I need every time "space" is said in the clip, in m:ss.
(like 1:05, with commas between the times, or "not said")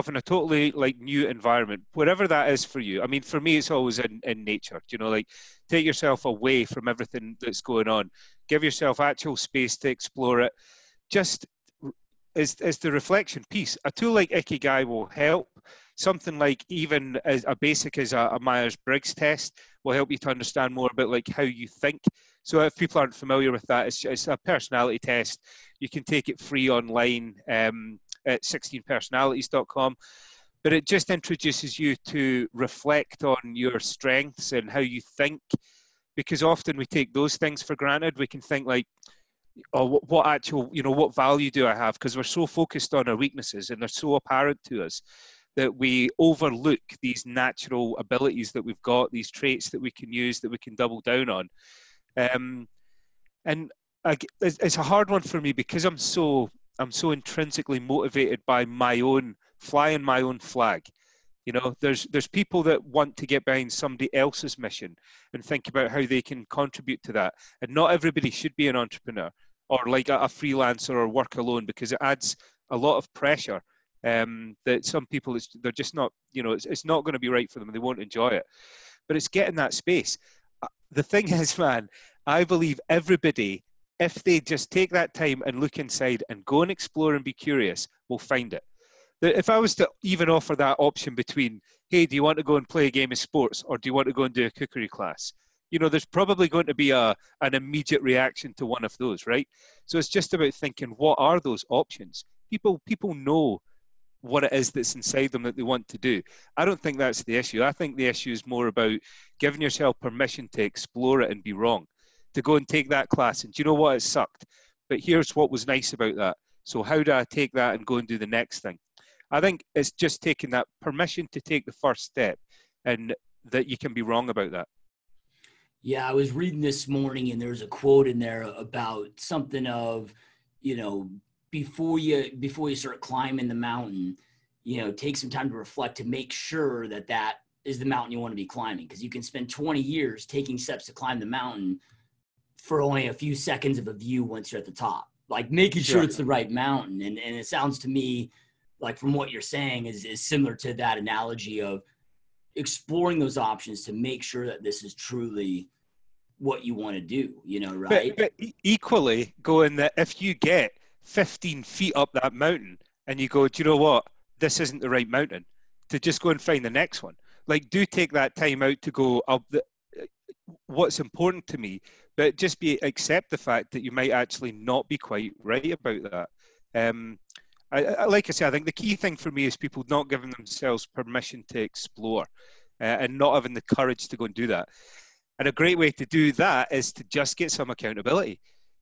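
0:09, 1:19.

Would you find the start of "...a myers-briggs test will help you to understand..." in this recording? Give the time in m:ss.
0:18.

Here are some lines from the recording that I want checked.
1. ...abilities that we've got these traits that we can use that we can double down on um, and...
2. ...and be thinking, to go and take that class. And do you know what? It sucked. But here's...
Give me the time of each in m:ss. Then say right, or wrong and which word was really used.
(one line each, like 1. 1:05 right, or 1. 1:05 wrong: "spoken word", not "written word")
1. 0:47 right
2. 1:51 wrong: "wrong", not "thinking".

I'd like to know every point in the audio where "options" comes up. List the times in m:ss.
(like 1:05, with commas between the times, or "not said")
1:30, 1:41, 2:33.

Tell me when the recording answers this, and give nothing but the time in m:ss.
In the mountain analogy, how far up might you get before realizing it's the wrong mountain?
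2:41.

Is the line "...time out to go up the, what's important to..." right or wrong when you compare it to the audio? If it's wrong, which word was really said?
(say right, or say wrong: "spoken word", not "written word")
right.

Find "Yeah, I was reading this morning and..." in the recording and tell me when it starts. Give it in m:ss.
2:05.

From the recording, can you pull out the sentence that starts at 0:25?
You can take it free online um, at 16personalities.com.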